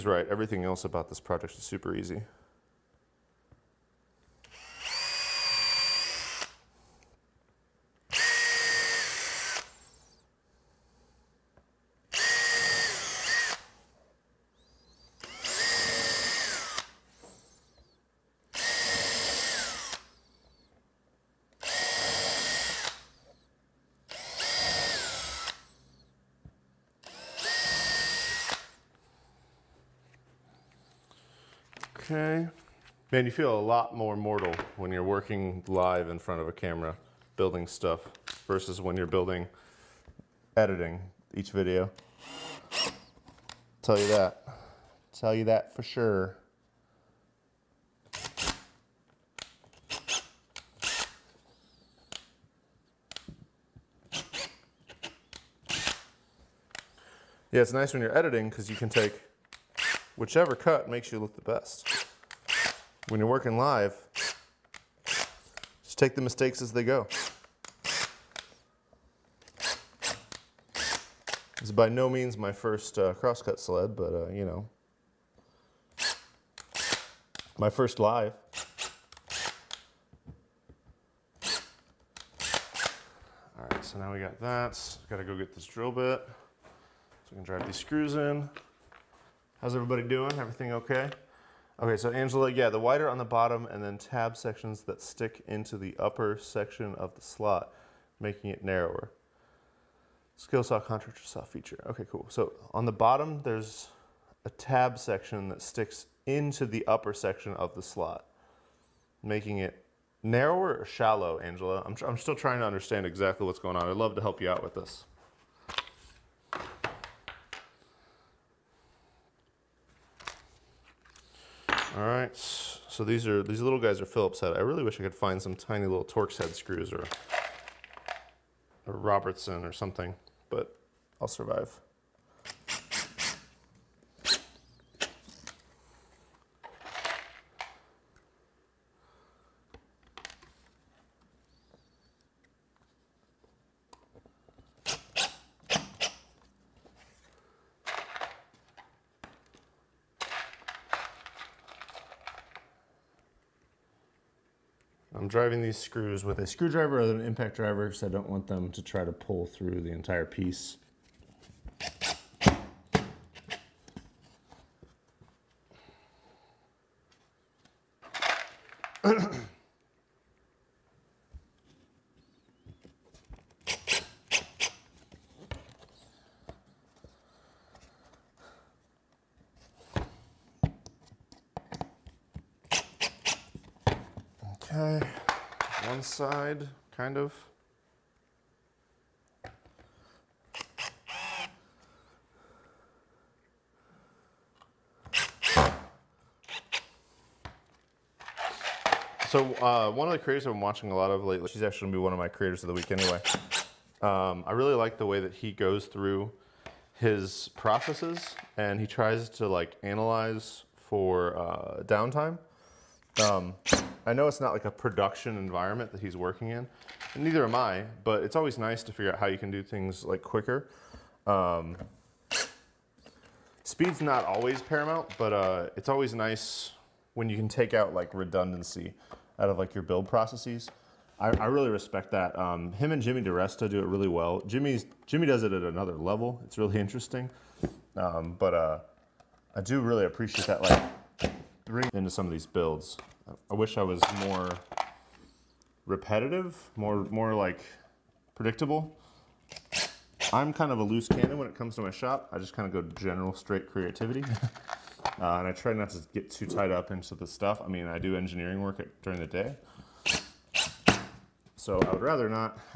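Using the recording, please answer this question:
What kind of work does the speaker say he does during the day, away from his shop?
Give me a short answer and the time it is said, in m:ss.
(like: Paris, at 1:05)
engineering, at 4:18.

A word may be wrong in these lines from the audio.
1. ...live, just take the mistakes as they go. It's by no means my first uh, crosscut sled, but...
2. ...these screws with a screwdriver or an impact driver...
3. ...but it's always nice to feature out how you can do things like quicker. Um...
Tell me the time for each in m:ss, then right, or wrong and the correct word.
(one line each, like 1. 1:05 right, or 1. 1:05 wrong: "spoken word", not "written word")
1. 1:03 right
2. 2:35 right
3. 3:38 wrong: "figure", not "feature".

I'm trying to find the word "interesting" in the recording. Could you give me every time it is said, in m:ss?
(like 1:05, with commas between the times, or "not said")
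3:56.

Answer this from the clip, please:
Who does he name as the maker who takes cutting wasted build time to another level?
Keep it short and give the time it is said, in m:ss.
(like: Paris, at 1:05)
Jimmy DeResta, at 3:53.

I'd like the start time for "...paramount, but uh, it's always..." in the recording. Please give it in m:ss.
3:44.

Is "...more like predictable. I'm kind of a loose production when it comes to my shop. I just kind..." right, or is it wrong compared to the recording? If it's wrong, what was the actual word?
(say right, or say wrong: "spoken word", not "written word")
wrong: "cannon", not "production".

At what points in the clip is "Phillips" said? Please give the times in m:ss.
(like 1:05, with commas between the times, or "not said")
2:04.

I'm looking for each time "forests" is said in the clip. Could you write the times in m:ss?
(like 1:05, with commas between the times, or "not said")
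not said.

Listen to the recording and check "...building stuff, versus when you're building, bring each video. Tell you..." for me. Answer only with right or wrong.
wrong.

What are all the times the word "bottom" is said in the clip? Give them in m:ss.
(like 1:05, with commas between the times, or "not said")
1:33, 1:42.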